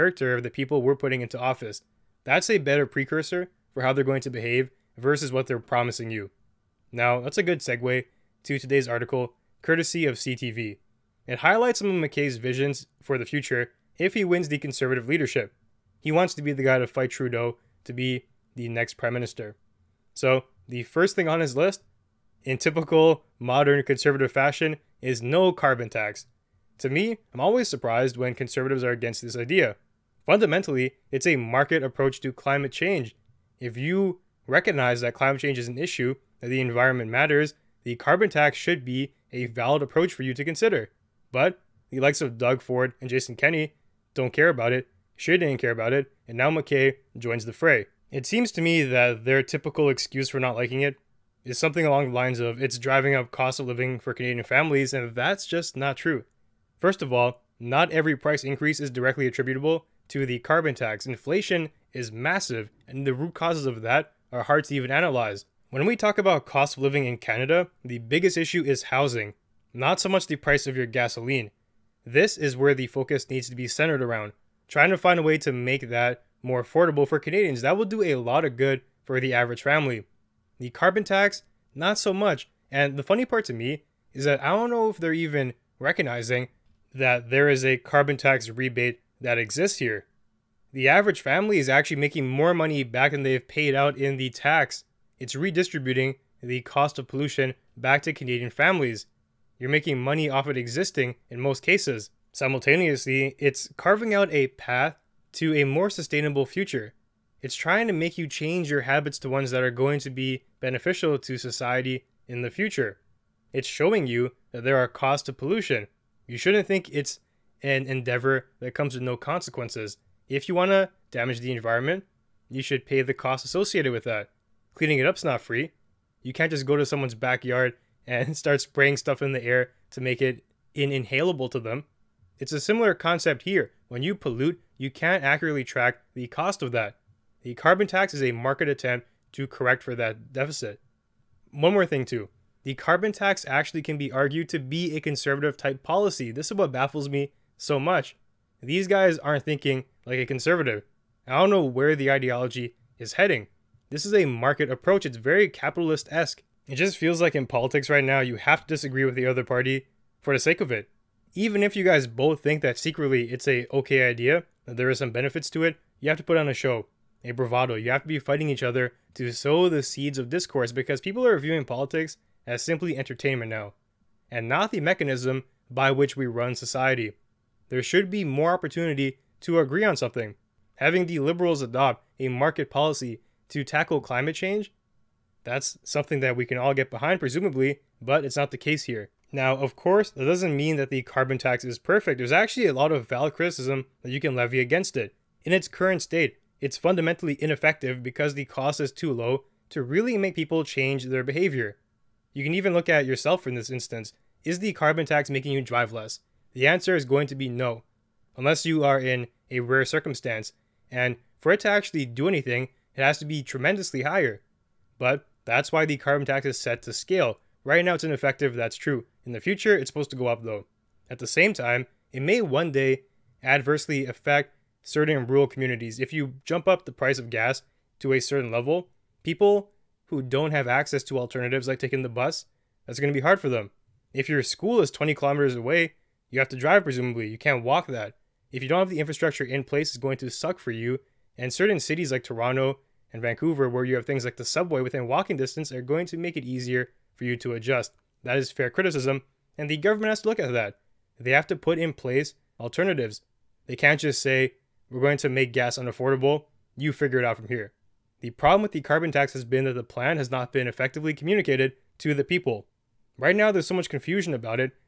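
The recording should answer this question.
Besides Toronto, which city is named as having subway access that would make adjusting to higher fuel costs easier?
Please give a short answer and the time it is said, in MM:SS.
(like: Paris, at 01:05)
Vancouver, at 04:03.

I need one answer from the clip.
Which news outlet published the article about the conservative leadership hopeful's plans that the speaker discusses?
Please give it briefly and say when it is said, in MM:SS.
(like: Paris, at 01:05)
CTV, at 00:10.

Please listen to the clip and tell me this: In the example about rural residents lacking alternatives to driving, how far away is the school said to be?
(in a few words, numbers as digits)
20 kilometers.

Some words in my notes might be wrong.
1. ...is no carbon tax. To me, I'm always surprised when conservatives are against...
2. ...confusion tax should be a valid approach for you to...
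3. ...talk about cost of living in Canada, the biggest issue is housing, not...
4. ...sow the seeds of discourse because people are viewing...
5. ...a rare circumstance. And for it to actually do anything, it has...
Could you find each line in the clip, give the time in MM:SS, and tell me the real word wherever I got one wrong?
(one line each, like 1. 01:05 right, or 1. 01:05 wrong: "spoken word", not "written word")
1. 00:25 right
2. 00:37 wrong: "carbon", not "confusion"
3. 01:05 right
4. 02:49 right
5. 03:29 right.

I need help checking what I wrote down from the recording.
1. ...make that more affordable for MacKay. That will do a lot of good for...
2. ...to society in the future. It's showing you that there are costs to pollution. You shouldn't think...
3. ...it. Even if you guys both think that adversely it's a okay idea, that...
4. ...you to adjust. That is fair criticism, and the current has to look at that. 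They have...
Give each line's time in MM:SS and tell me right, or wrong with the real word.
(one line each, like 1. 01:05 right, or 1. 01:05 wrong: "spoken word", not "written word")
1. 01:15 wrong: "Canadians", not "MacKay"
2. 01:51 right
3. 02:40 wrong: "secretly", not "adversely"
4. 04:07 wrong: "government", not "current".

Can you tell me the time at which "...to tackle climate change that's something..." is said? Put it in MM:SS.
03:03.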